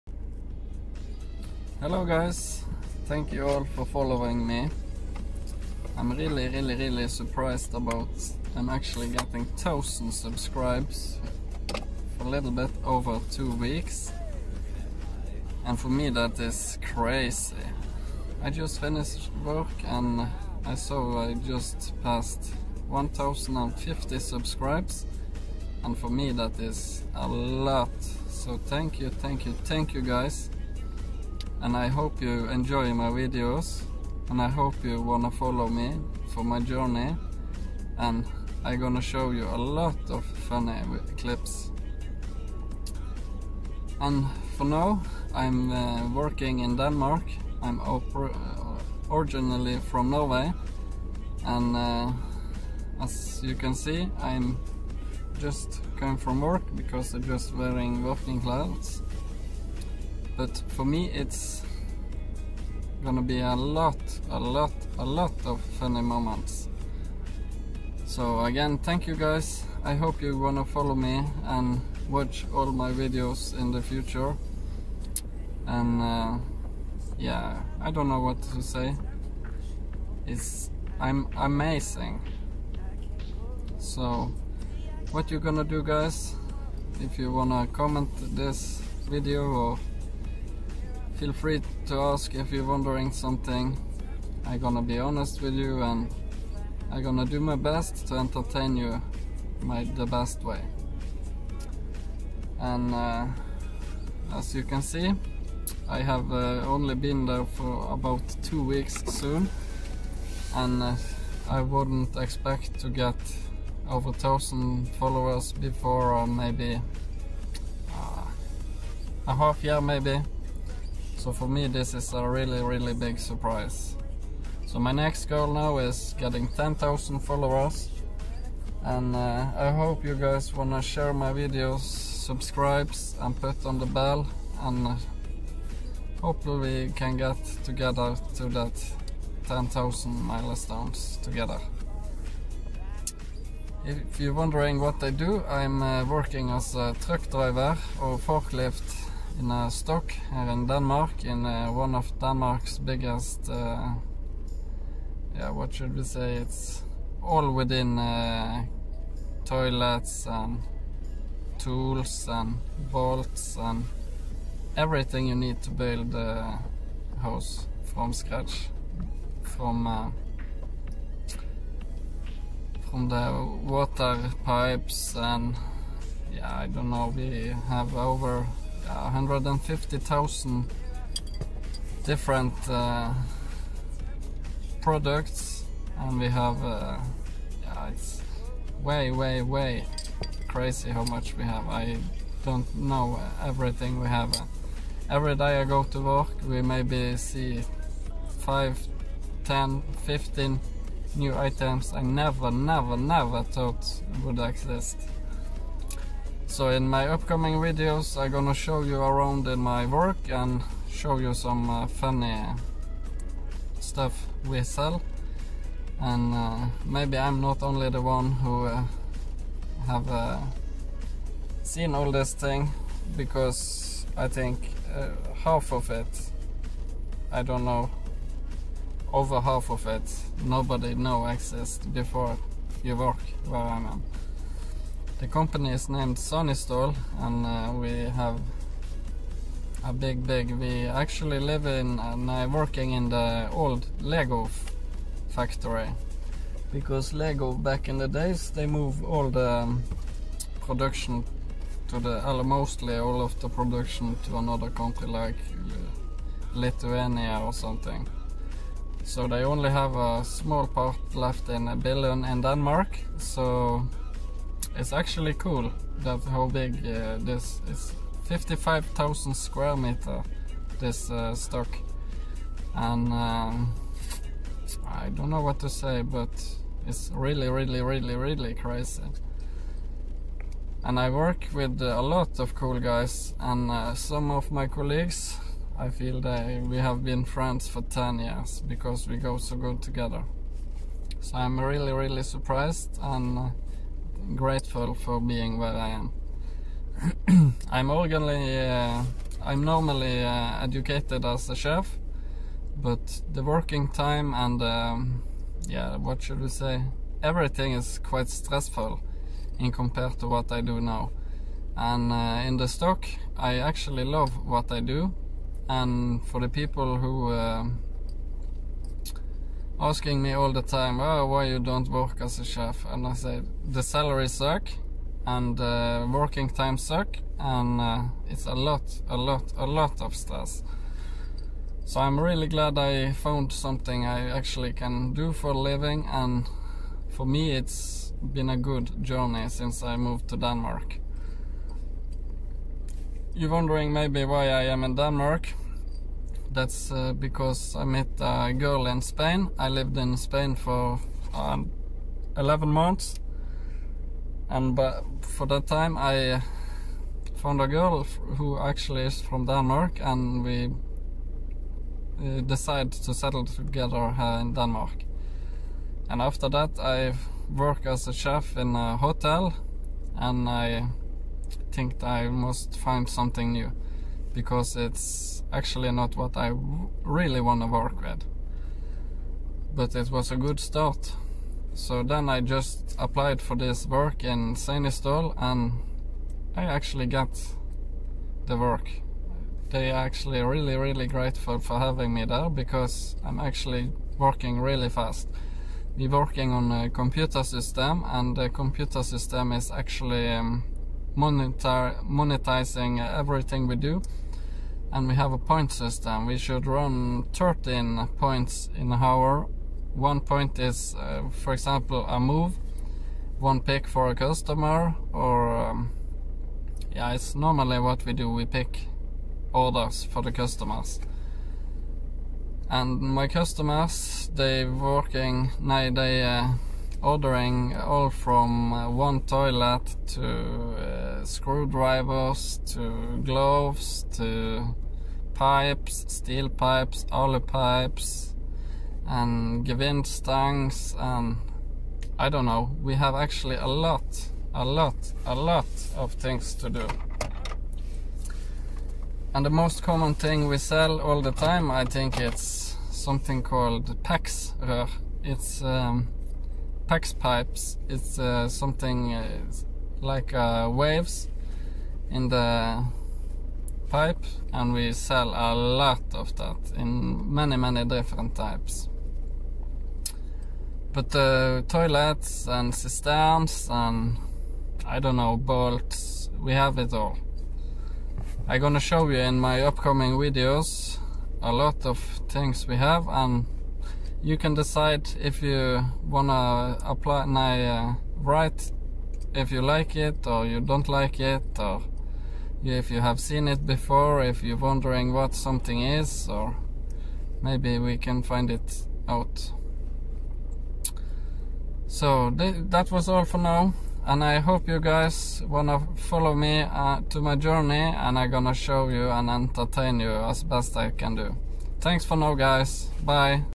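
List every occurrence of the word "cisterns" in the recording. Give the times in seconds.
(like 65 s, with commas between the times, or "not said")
472 s.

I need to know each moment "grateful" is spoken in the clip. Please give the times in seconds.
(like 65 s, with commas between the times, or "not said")
294 s, 391 s.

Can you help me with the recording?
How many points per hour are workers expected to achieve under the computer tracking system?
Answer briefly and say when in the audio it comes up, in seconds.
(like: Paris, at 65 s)
13, at 407 s.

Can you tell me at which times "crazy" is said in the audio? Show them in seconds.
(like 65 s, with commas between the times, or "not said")
16 s, 190 s, 278 s.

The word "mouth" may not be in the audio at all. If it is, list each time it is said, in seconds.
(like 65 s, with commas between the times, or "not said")
not said.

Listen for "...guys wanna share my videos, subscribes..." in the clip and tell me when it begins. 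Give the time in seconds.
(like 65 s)
130 s.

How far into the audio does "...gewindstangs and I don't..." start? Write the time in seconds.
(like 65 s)
439 s.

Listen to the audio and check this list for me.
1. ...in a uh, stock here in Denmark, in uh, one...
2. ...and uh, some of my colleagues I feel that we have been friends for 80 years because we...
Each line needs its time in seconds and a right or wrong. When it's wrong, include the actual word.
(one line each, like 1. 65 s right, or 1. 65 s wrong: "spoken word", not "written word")
1. 149 s right
2. 283 s wrong: "10", not "80".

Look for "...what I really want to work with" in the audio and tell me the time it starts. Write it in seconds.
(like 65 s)
376 s.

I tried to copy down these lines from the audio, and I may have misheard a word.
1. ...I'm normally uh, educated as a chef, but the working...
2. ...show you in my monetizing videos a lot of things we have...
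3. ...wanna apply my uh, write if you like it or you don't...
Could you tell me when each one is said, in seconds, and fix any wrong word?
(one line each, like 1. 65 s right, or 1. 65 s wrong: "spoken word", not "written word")
1. 299 s right
2. 478 s wrong: "upcoming", not "monetizing"
3. 486 s right.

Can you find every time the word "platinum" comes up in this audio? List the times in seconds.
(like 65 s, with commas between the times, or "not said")
not said.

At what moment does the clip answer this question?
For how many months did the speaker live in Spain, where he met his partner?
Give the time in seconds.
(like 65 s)
352 s.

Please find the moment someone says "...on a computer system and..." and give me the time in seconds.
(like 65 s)
396 s.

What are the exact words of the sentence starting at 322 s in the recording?
And I said, the salary suck and uh, working time suck and uh, it's a lot, a lot, a lot of stress.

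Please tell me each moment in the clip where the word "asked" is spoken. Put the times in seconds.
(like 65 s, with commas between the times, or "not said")
not said.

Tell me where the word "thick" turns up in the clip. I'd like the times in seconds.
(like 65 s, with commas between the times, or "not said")
not said.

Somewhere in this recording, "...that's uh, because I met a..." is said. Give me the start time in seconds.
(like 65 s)
346 s.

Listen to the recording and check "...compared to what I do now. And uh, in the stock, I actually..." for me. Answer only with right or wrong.
right.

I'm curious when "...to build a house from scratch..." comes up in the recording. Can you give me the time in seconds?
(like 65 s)
165 s.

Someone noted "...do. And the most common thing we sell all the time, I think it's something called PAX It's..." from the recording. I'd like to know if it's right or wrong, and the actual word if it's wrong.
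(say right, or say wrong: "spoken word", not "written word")
right.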